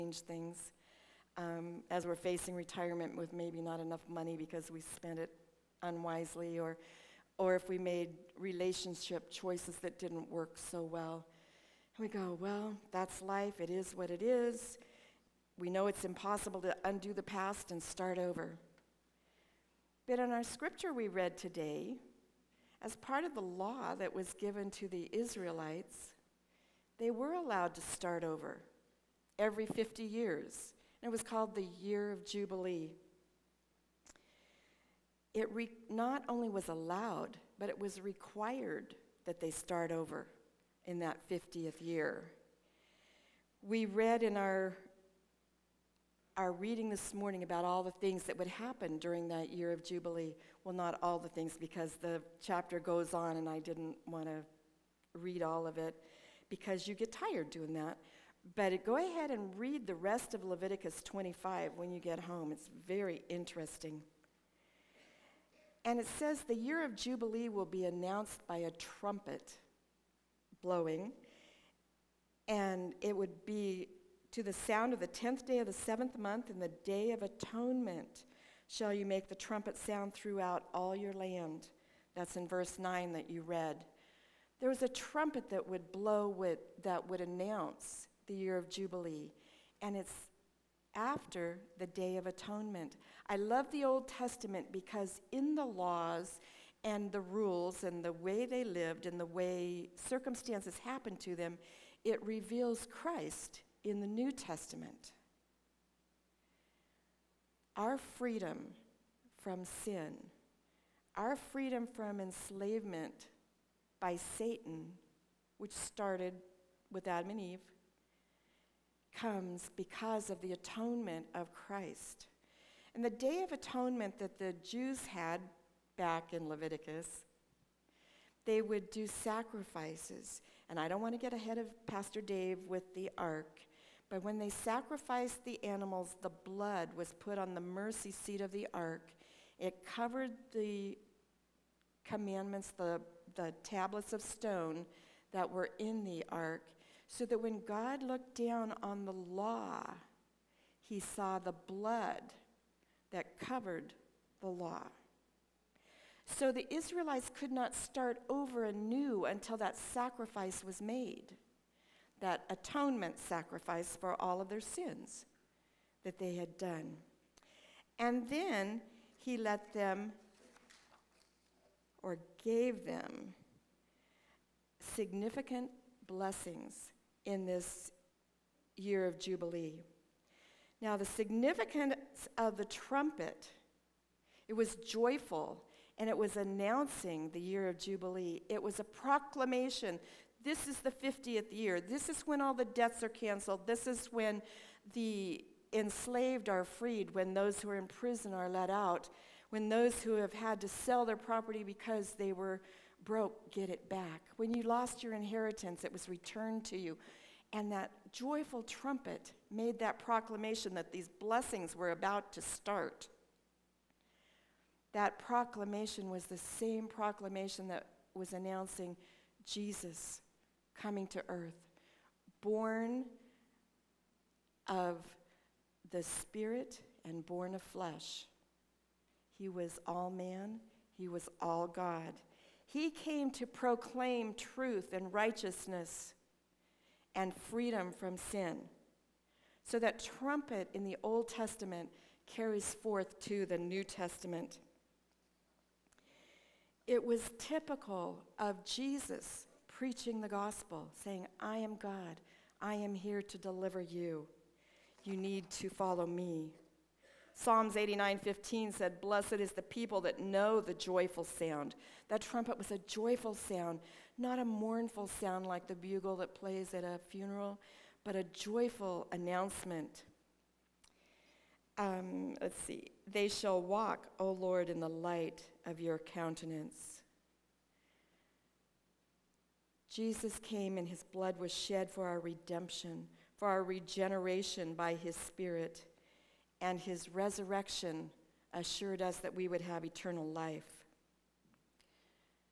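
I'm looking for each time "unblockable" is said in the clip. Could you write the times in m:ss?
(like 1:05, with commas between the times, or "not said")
not said.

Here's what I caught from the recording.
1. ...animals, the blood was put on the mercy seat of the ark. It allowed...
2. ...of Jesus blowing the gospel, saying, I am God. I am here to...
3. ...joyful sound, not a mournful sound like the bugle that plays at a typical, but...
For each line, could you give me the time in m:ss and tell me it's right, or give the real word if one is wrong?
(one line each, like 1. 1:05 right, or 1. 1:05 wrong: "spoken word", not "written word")
1. 2:15 wrong: "covered", not "allowed"
2. 4:08 wrong: "preaching", not "blowing"
3. 4:22 wrong: "funeral", not "typical".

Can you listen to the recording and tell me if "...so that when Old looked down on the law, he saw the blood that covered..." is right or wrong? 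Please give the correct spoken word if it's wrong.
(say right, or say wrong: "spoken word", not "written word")
wrong: "God", not "Old".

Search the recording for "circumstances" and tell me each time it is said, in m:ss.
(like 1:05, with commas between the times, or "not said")
1:39.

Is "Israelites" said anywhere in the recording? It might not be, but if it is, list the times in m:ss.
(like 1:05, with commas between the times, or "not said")
0:25, 2:36.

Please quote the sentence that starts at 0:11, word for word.
And we go, well, that's life, it is what it is.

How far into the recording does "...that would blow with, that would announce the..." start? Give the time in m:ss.
1:25.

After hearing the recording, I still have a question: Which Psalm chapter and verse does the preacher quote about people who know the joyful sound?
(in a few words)
Psalms 89:15.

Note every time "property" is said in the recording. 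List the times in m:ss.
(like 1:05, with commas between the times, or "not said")
3:21.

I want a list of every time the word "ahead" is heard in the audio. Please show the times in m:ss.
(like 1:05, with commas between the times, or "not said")
0:58, 2:11.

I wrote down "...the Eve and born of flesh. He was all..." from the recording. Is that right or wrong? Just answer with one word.
wrong.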